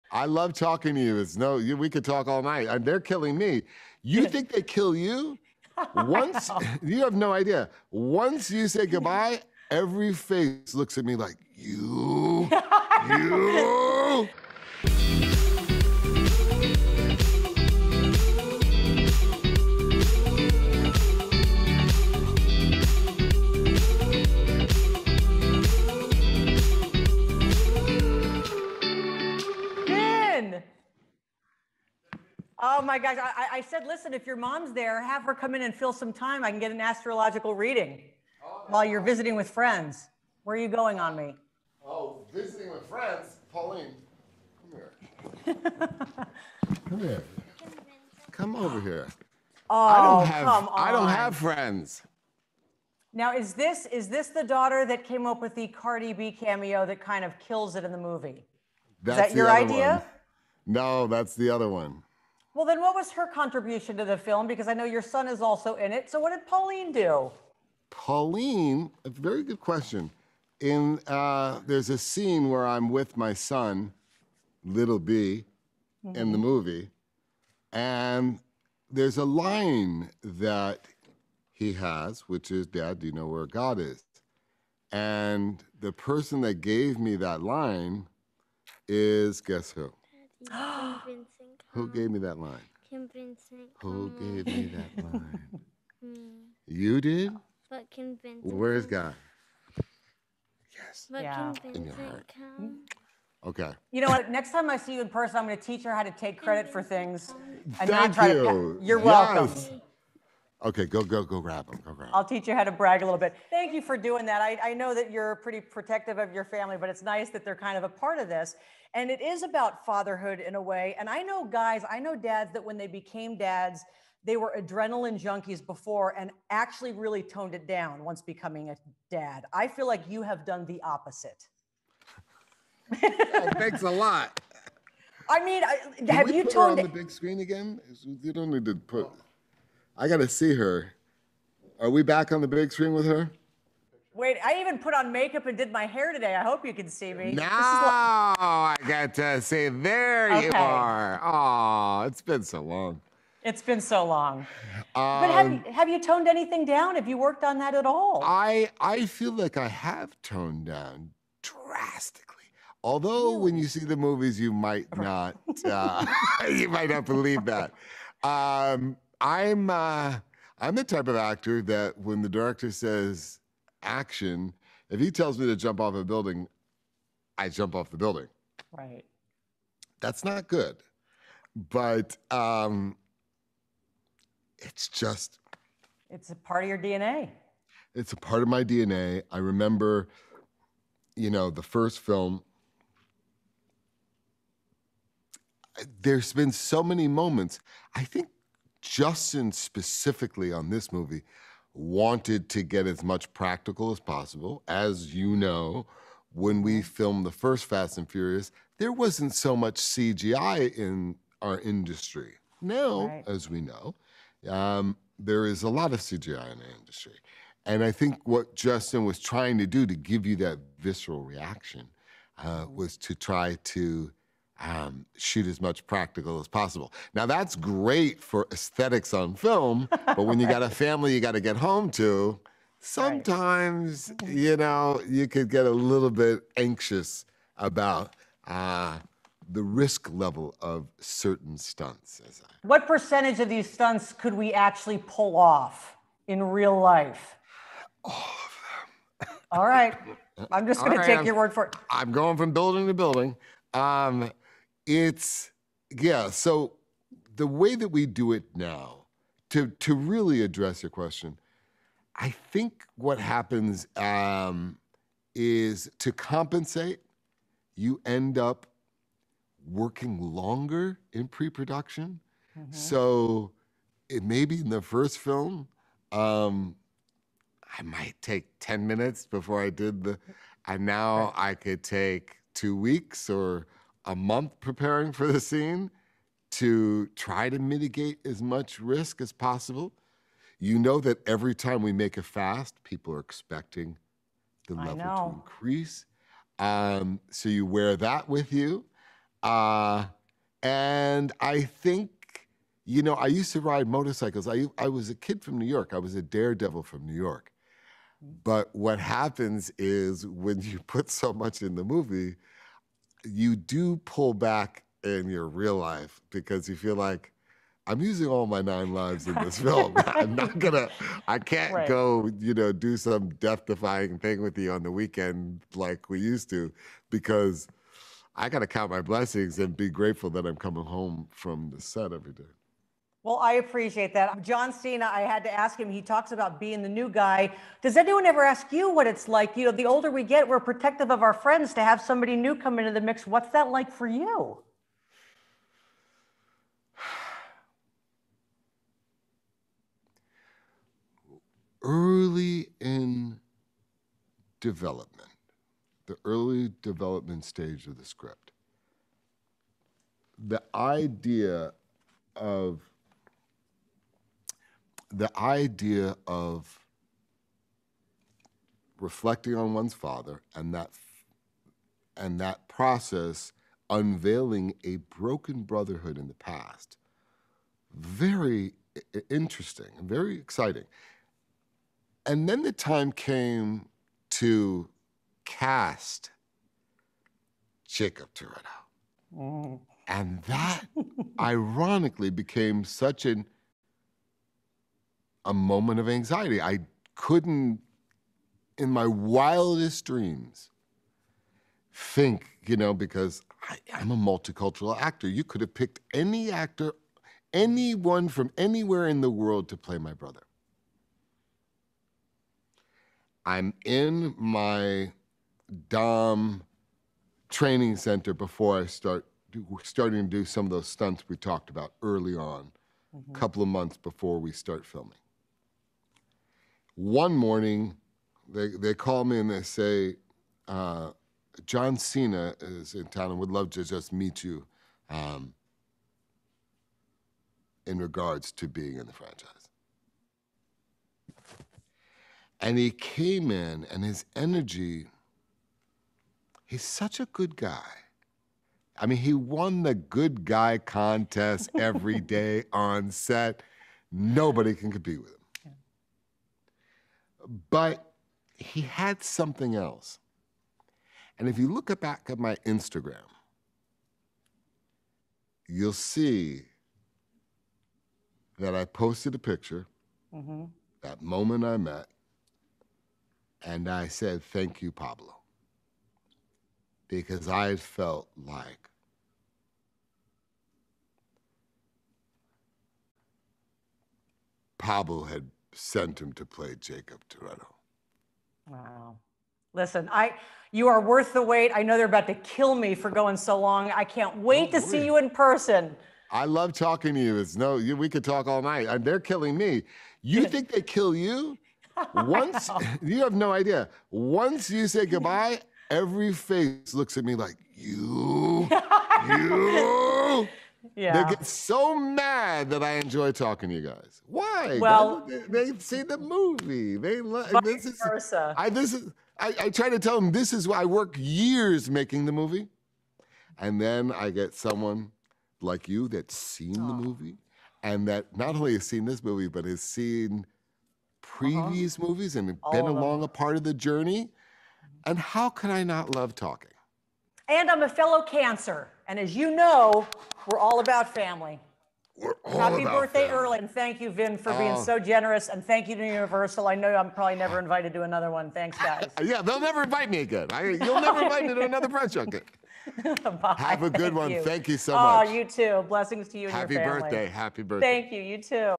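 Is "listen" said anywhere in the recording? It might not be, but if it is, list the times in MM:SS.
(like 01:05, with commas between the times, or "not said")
00:33, 08:09.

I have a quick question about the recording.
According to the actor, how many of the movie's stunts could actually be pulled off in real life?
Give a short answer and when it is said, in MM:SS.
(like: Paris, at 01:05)
All of them, at 04:08.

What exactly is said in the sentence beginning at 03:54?
you know you could get a little bit anxious about uh, the risk level of certain stunts.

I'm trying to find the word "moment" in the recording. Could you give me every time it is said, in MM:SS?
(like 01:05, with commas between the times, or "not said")
03:17, 06:35, 07:51.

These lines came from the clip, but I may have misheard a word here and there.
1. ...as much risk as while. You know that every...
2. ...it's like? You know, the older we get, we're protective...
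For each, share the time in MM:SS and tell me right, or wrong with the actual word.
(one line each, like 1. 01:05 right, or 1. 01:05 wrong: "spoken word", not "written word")
1. 04:48 wrong: "possible", not "while"
2. 05:39 right.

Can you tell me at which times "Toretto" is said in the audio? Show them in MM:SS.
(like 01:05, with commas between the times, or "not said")
06:28, 08:07.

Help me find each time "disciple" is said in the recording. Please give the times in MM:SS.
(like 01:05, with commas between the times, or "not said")
not said.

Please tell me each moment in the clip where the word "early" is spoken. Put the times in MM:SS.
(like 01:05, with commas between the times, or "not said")
05:51, 05:56, 07:02.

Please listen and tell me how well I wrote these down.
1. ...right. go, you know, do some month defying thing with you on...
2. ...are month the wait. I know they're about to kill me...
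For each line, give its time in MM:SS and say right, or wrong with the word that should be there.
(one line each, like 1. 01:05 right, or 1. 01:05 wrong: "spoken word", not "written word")
1. 05:21 wrong: "death", not "month"
2. 08:10 wrong: "worth", not "month".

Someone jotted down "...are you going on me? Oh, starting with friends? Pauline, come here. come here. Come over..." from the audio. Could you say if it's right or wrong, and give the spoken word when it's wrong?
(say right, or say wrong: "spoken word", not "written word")
wrong: "visiting", not "starting".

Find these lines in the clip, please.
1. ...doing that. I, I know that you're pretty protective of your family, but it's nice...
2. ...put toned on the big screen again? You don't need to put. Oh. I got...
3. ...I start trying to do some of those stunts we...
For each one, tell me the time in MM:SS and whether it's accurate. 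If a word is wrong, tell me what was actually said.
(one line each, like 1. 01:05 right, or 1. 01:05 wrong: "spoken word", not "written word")
1. 01:53 right
2. 02:16 right
3. 06:58 wrong: "starting", not "trying".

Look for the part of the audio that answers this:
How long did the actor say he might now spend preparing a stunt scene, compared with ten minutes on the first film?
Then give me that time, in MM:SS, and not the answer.
04:42.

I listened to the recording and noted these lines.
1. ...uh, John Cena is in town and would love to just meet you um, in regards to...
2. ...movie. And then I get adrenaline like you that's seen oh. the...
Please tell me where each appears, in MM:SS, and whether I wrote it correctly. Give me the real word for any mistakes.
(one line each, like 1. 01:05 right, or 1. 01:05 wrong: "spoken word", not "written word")
1. 07:10 right
2. 08:42 wrong: "someone", not "adrenaline".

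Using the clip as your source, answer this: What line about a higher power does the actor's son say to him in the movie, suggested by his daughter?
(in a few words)
Dad, do you know where God is?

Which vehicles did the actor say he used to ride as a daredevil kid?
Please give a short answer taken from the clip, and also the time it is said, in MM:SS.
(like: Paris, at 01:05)
Motorcycles, at 05:03.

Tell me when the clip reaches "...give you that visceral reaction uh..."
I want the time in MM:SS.
03:39.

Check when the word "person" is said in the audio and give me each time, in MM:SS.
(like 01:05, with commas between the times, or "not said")
01:25, 01:45, 08:15.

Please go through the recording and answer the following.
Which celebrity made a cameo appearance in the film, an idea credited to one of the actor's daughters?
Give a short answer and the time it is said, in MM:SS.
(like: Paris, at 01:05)
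Cardi B, at 00:55.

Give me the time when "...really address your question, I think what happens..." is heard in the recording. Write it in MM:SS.
04:19.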